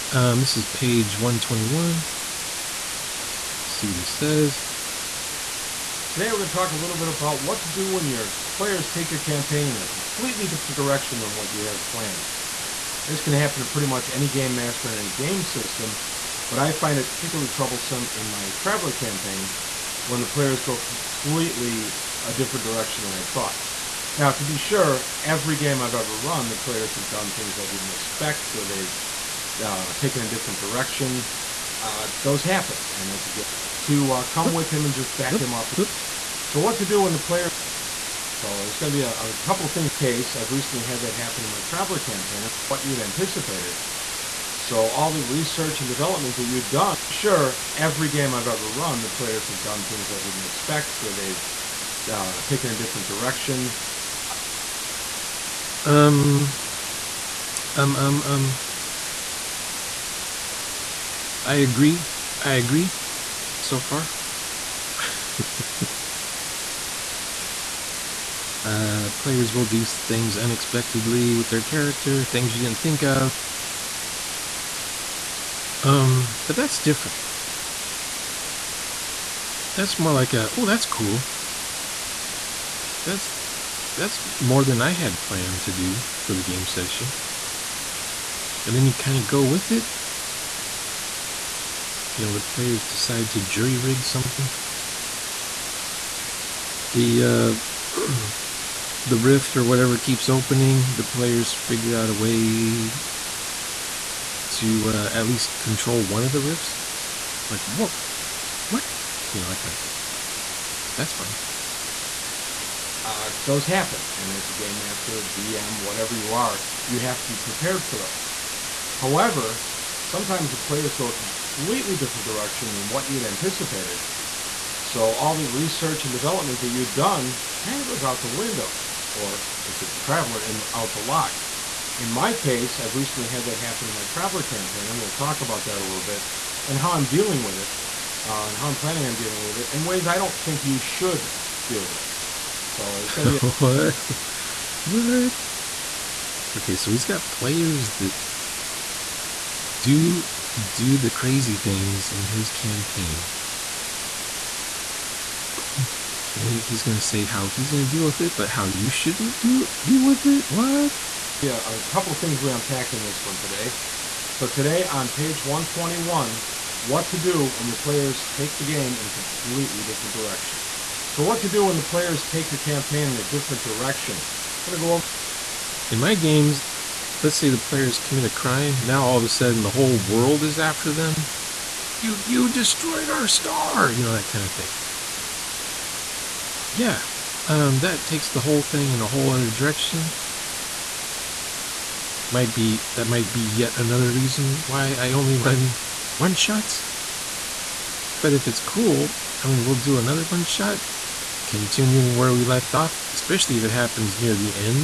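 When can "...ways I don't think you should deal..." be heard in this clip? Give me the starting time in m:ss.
2:19.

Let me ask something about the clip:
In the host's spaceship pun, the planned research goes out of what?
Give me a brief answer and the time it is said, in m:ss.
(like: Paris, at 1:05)
the lock, at 2:10.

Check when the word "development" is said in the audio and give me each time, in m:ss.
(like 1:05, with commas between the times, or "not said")
0:45, 2:06.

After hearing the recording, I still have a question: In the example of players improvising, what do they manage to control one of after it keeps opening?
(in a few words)
the rifts.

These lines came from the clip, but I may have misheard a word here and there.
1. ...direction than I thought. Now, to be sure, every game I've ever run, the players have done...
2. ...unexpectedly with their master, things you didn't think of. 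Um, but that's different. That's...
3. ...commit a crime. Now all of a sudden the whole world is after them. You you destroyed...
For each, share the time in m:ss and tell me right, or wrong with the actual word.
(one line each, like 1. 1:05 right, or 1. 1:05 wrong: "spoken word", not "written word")
1. 0:22 right
2. 1:10 wrong: "character", not "master"
3. 2:57 right.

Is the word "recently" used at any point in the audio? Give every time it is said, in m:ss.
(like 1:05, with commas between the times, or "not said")
0:40, 2:12.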